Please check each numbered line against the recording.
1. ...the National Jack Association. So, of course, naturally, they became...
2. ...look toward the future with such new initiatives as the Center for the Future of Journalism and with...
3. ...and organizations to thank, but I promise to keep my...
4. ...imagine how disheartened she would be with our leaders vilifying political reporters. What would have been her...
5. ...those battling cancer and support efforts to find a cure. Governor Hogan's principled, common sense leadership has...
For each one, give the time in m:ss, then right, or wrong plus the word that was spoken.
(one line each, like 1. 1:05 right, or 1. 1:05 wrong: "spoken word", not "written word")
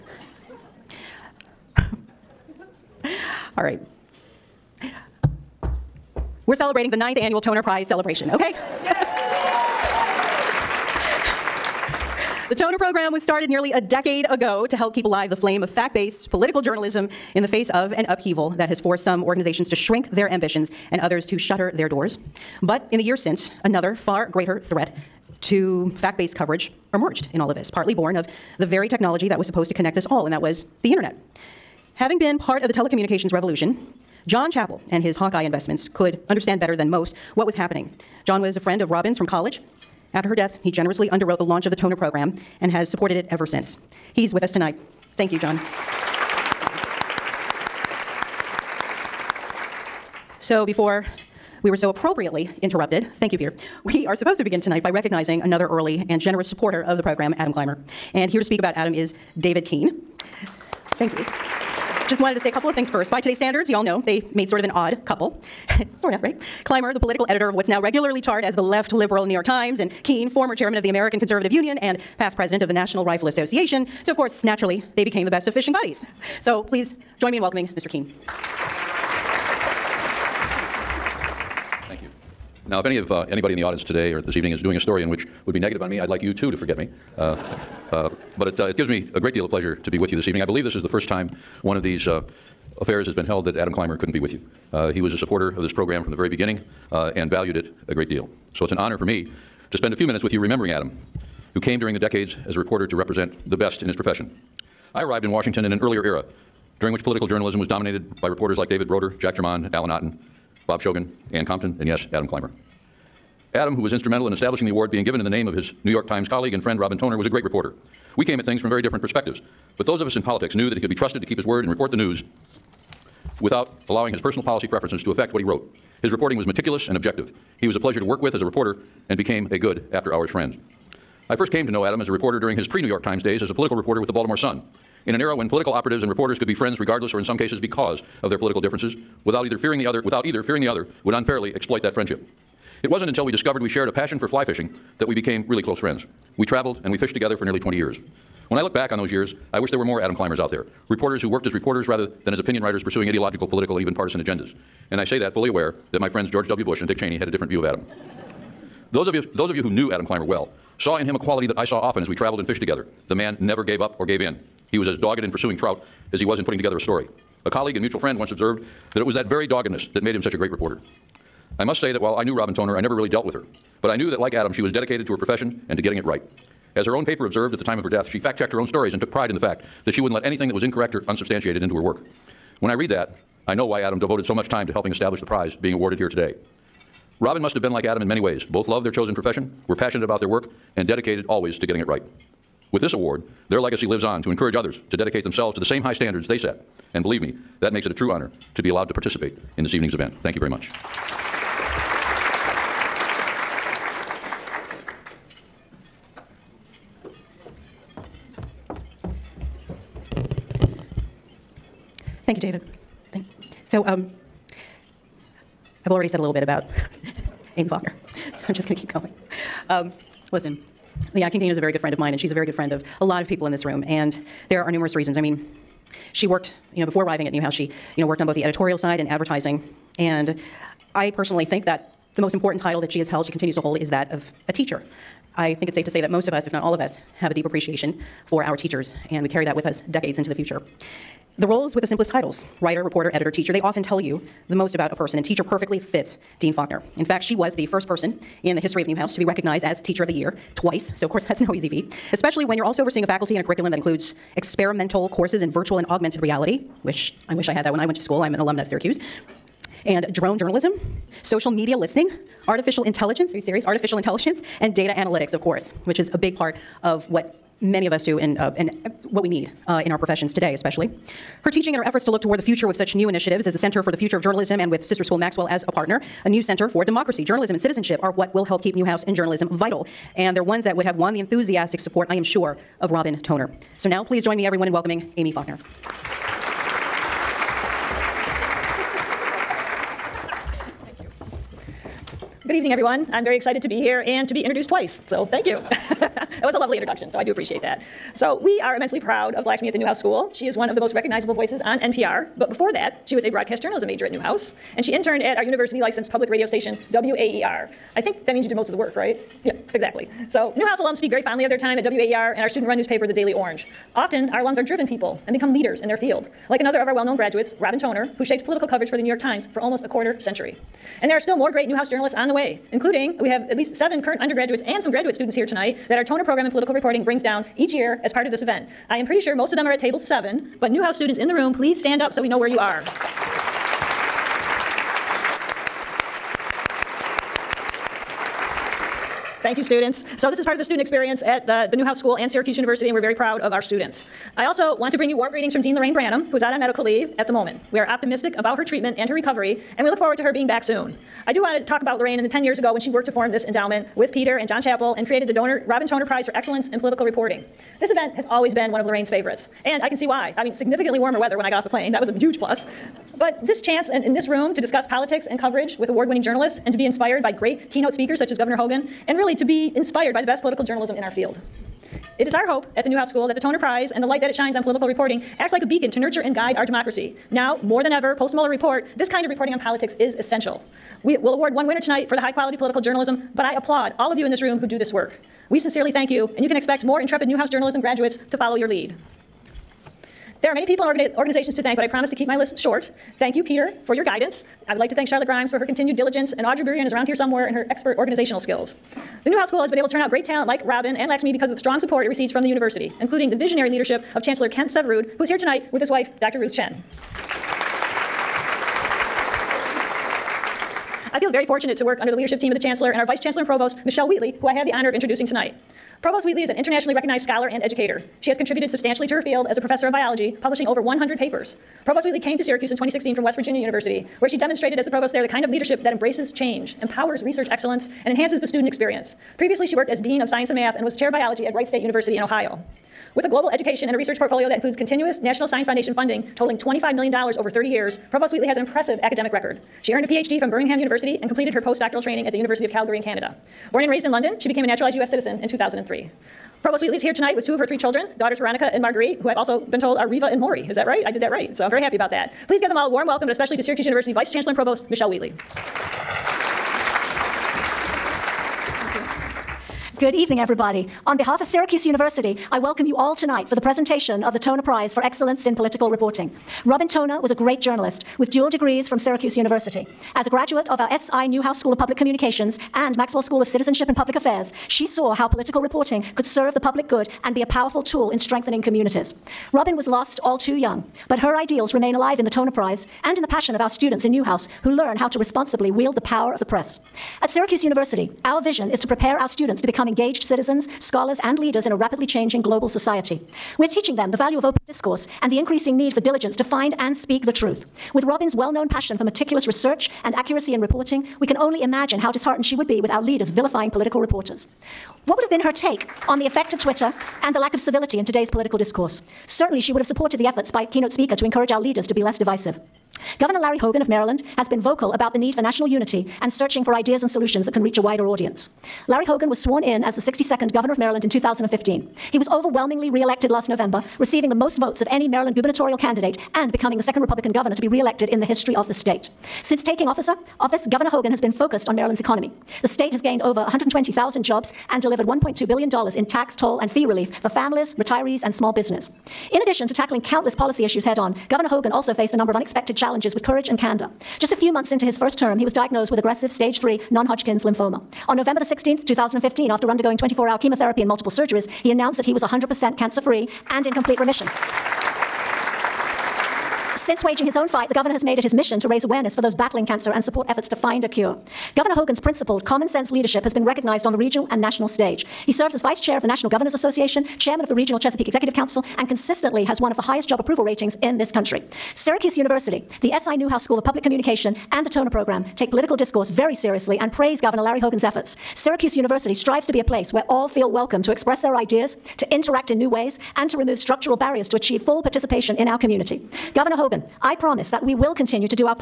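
1. 1:12 wrong: "Rifle", not "Jack"
2. 4:32 right
3. 6:30 right
4. 8:21 right
5. 9:19 right.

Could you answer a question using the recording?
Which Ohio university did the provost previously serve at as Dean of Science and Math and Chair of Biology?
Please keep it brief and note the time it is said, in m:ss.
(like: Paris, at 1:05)
Wright State University, at 7:11.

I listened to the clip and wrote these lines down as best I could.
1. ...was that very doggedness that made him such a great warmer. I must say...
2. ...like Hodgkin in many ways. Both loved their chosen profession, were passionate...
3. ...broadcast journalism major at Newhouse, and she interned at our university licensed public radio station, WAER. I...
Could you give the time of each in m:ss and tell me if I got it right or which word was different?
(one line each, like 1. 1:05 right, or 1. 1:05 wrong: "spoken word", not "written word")
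1. 2:49 wrong: "reporter", not "warmer"
2. 3:07 wrong: "Adam", not "Hodgkin"
3. 5:03 right.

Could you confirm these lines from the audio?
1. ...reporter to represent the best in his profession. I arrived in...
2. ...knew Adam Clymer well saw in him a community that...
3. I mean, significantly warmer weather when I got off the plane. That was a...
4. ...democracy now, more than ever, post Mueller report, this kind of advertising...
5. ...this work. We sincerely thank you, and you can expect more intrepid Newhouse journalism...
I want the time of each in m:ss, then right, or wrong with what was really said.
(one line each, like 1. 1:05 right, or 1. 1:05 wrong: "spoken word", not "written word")
1. 1:42 right
2. 2:39 wrong: "quality", not "community"
3. 6:00 right
4. 6:16 wrong: "reporting", not "advertising"
5. 6:24 right.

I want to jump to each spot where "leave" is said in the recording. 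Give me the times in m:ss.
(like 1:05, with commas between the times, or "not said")
5:46.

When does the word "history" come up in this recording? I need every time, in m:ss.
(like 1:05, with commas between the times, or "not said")
4:08, 8:48.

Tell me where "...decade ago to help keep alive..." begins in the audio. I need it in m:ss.
0:13.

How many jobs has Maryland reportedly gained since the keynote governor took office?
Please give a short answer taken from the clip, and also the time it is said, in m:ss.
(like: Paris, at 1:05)
120,000, at 8:53.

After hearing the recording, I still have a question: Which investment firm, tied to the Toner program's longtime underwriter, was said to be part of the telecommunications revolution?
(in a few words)
Hawkeye.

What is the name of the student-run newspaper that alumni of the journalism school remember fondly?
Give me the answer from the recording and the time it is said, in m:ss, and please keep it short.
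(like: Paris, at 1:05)
The Daily Orange, at 5:13.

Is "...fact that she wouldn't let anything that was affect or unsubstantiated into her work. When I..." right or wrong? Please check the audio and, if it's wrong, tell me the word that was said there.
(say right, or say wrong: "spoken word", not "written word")
wrong: "incorrect", not "affect".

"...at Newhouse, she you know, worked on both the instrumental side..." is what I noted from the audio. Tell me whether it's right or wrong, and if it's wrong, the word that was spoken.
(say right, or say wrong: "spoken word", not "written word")
wrong: "editorial", not "instrumental".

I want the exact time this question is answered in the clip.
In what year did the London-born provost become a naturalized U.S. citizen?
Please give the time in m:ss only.
7:25.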